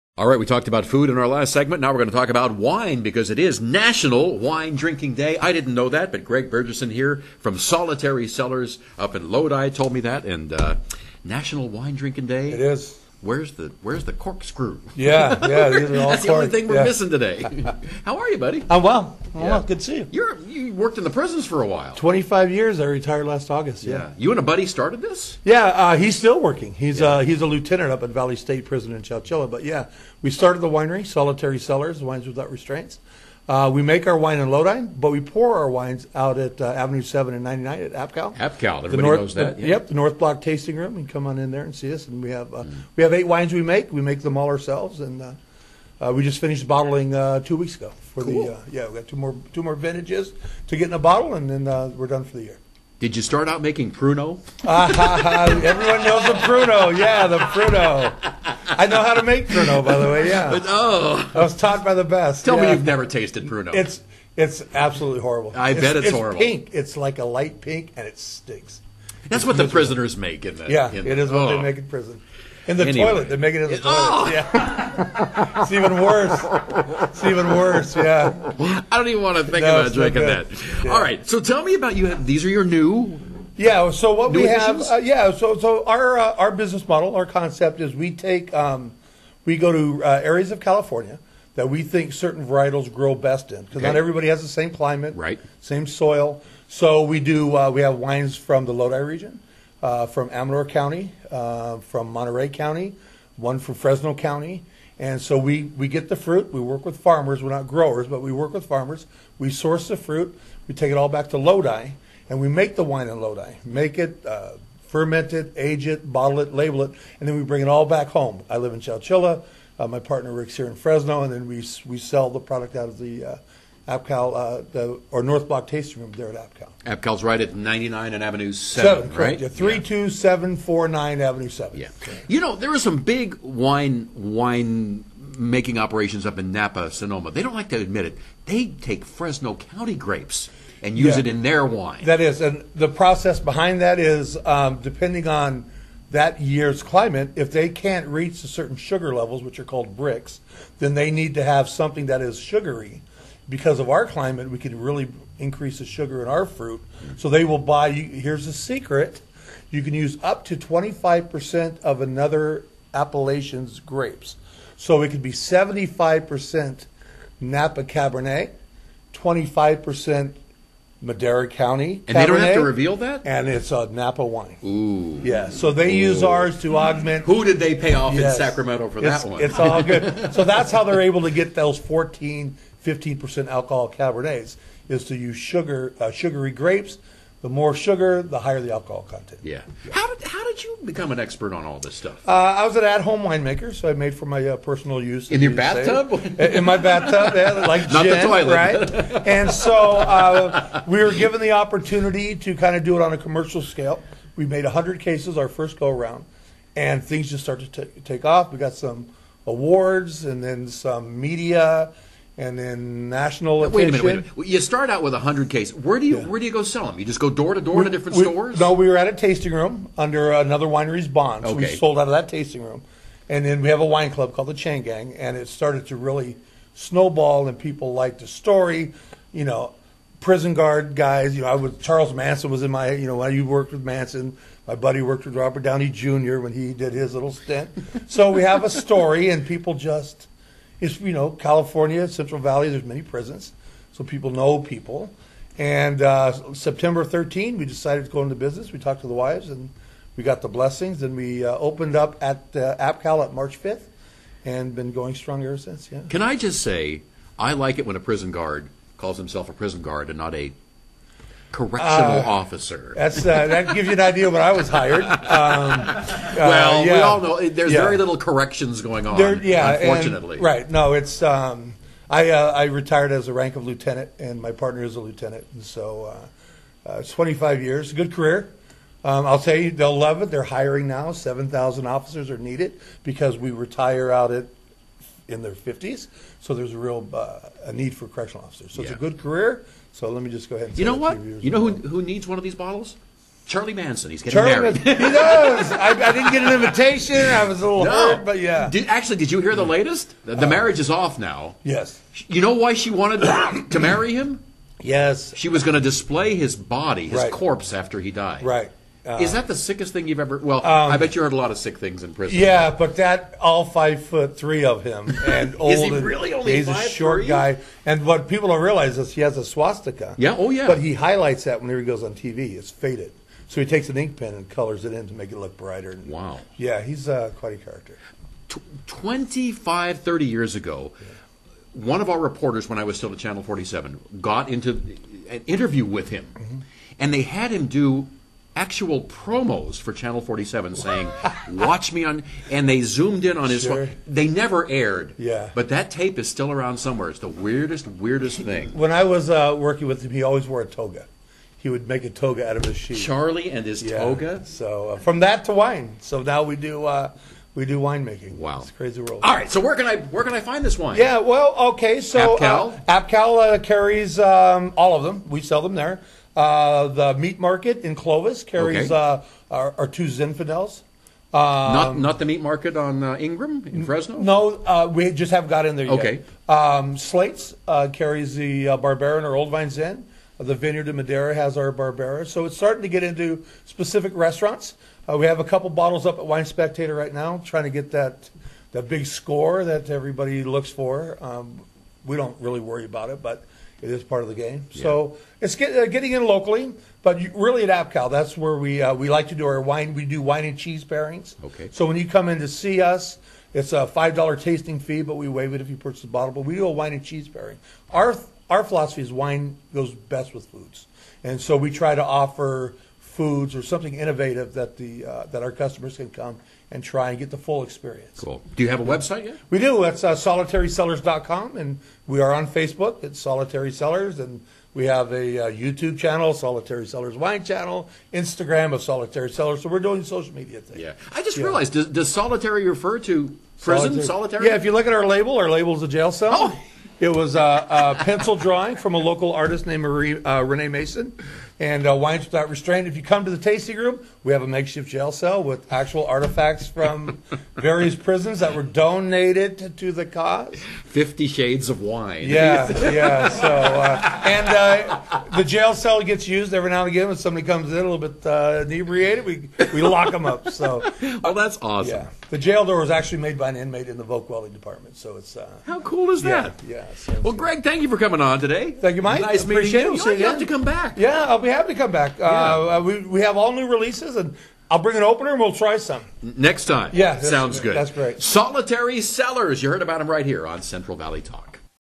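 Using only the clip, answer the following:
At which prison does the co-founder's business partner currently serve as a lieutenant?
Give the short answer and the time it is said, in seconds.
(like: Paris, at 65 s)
Valley State Prison, at 28 s.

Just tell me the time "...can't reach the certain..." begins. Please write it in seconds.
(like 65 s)
147 s.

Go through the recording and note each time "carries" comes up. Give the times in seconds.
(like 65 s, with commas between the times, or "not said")
363 s, 368 s, 377 s.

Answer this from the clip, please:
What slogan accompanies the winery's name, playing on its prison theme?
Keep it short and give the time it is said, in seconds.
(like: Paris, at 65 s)
Wines Without Restraints, at 32 s.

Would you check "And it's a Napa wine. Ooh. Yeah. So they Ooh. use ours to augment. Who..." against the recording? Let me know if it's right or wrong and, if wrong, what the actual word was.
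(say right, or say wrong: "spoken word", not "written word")
right.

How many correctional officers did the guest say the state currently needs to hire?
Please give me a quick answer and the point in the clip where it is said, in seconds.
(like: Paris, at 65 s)
7,000, at 281 s.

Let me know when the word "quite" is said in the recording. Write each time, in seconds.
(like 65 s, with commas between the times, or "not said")
327 s.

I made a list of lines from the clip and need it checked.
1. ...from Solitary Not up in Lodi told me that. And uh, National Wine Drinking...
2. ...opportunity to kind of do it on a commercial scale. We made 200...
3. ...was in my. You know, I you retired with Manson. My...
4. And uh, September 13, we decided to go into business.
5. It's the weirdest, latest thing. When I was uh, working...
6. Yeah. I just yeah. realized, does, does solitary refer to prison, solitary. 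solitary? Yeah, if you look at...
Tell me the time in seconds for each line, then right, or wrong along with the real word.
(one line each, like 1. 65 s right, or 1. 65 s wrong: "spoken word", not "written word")
1. 7 s wrong: "Cellars", not "Not"
2. 201 s wrong: "100", not "200"
3. 232 s wrong: "worked", not "retired"
4. 245 s right
5. 347 s wrong: "weirdest", not "latest"
6. 430 s right.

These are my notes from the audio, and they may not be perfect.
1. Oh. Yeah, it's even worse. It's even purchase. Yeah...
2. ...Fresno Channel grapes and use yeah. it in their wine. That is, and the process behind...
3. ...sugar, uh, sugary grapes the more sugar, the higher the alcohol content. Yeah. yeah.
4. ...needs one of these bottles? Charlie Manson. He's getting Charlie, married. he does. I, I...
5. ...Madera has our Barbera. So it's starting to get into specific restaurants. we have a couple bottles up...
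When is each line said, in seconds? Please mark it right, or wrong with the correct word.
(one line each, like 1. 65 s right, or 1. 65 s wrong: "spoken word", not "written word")
1. 74 s wrong: "worse", not "purchase"
2. 139 s wrong: "County", not "Channel"
3. 185 s right
4. 292 s right
5. 380 s right.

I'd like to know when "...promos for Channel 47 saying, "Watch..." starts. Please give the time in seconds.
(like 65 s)
339 s.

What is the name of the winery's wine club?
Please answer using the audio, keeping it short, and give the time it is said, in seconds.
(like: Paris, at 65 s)
Chain Gang, at 224 s.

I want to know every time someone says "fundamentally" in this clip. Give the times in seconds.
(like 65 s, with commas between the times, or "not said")
not said.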